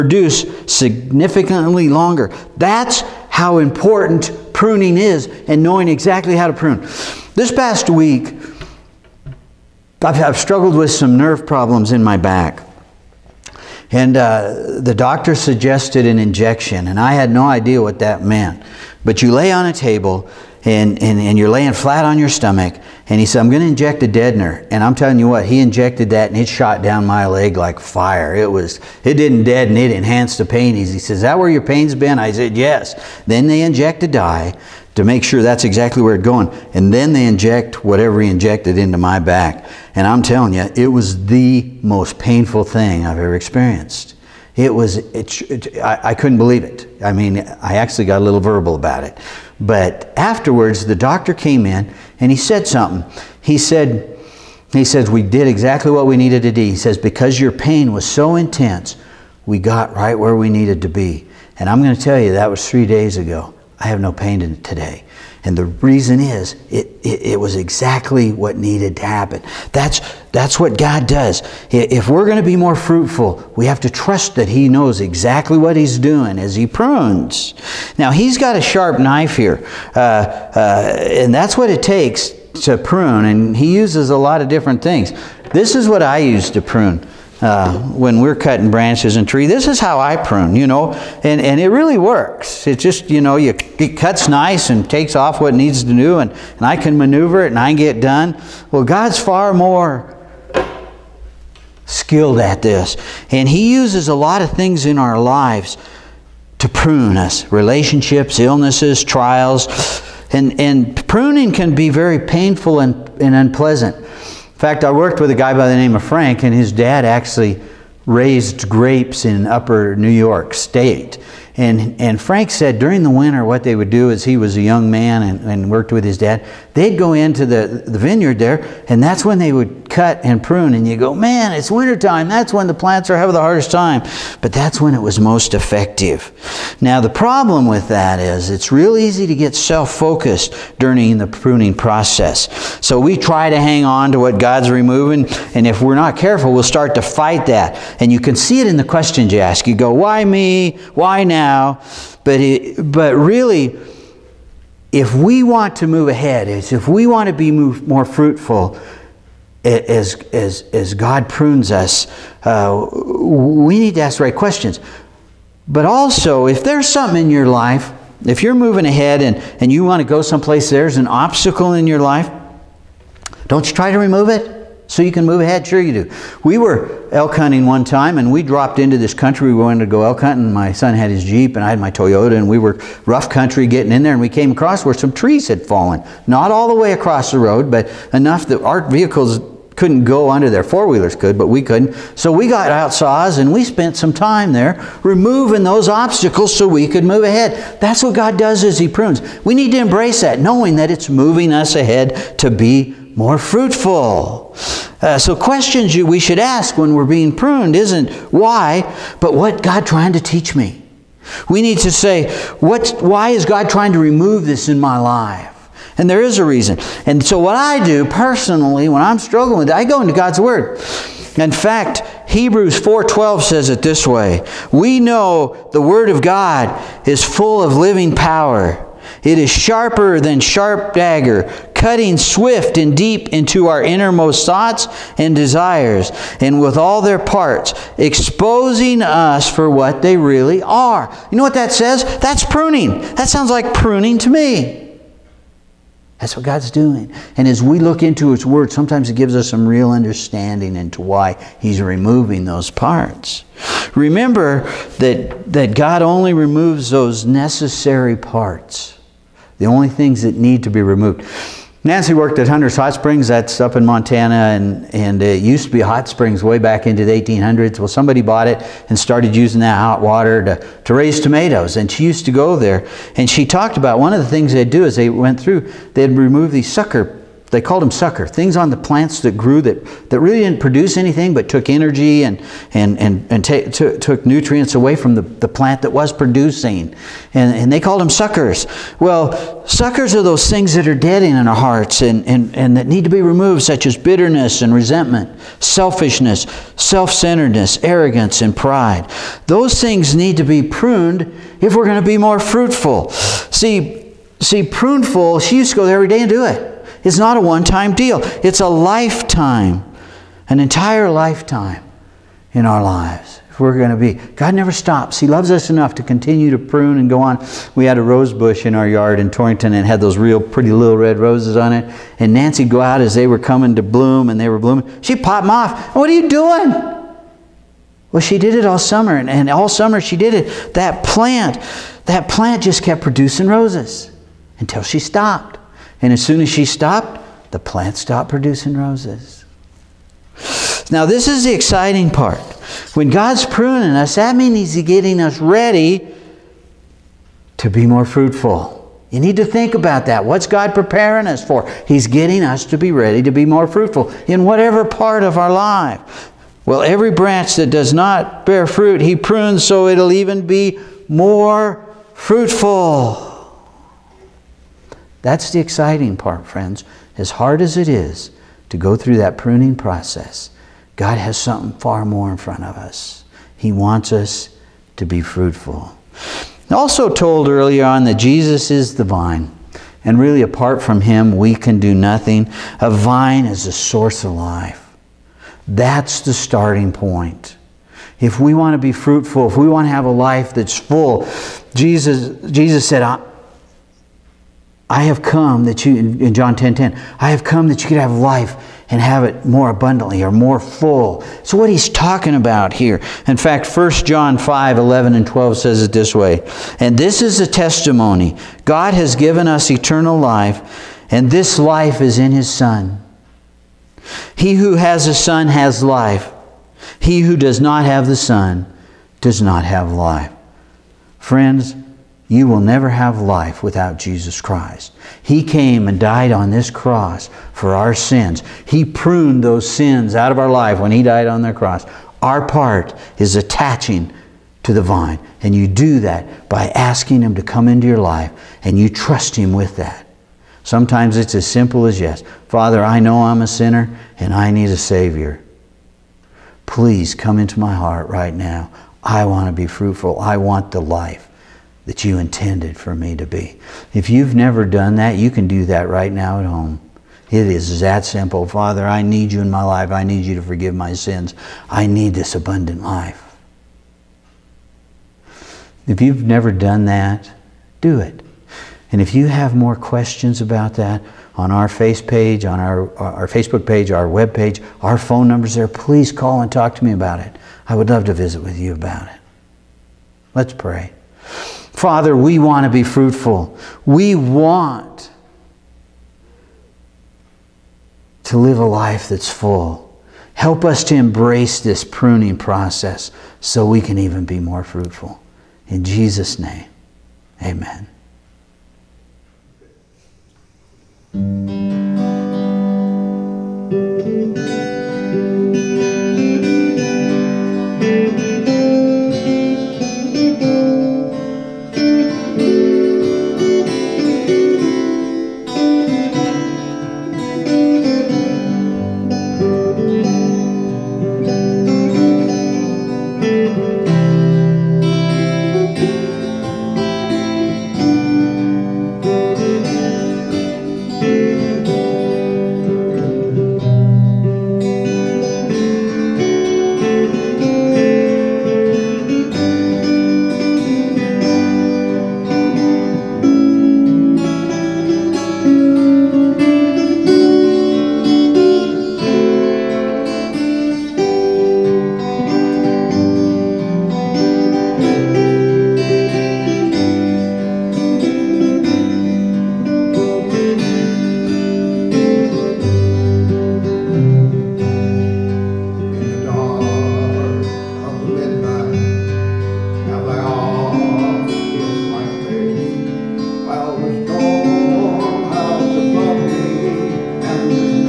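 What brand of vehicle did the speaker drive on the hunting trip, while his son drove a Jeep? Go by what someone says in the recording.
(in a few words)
Toyota.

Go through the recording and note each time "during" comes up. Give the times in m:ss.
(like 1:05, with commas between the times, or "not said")
2:02, 2:20.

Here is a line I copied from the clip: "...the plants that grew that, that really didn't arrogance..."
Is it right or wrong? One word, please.
wrong.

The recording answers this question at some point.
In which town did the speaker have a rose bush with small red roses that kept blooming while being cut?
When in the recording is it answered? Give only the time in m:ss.
5:19.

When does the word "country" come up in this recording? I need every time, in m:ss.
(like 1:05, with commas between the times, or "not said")
2:59, 3:03.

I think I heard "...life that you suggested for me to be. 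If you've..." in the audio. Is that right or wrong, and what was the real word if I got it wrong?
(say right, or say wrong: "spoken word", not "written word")
wrong: "intended", not "suggested".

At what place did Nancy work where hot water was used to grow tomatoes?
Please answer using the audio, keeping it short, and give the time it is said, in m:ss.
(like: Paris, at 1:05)
Hunter's Hot Springs, at 4:22.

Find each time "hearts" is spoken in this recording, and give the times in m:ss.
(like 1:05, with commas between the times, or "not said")
4:51, 7:27.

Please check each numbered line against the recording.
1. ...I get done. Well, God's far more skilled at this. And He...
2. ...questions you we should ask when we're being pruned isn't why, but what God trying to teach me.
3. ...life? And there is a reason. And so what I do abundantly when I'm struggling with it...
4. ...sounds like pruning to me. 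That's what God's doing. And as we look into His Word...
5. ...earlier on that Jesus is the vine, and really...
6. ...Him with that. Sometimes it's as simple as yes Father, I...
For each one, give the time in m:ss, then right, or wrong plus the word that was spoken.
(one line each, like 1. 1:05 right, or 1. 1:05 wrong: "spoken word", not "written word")
1. 1:37 right
2. 3:25 right
3. 3:34 wrong: "personally", not "abundantly"
4. 4:03 right
5. 6:17 right
6. 7:19 right.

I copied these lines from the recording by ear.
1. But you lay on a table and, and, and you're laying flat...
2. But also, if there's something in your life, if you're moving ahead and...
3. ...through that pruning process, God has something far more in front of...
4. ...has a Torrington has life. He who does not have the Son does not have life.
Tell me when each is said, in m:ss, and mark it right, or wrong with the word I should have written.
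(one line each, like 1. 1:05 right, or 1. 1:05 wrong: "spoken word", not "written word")
1. 0:19 right
2. 2:45 right
3. 6:08 right
4. 6:54 wrong: "Son", not "Torrington".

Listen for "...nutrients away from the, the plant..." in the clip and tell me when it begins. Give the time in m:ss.
4:44.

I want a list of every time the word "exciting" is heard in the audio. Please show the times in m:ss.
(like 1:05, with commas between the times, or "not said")
5:41, 6:05.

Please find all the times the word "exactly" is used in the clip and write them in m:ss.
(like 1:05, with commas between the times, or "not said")
0:05, 0:35, 0:55, 1:07, 1:14.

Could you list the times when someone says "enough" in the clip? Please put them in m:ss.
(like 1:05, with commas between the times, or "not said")
3:08, 5:15.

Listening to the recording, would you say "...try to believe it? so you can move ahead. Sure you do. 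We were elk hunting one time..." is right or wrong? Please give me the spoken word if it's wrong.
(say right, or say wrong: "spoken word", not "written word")
wrong: "remove", not "believe".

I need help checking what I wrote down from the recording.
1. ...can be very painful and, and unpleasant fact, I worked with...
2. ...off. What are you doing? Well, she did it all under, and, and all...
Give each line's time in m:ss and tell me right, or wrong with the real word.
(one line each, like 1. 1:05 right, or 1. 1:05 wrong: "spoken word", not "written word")
1. 1:51 right
2. 5:25 wrong: "summer", not "under".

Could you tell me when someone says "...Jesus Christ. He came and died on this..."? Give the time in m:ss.
7:03.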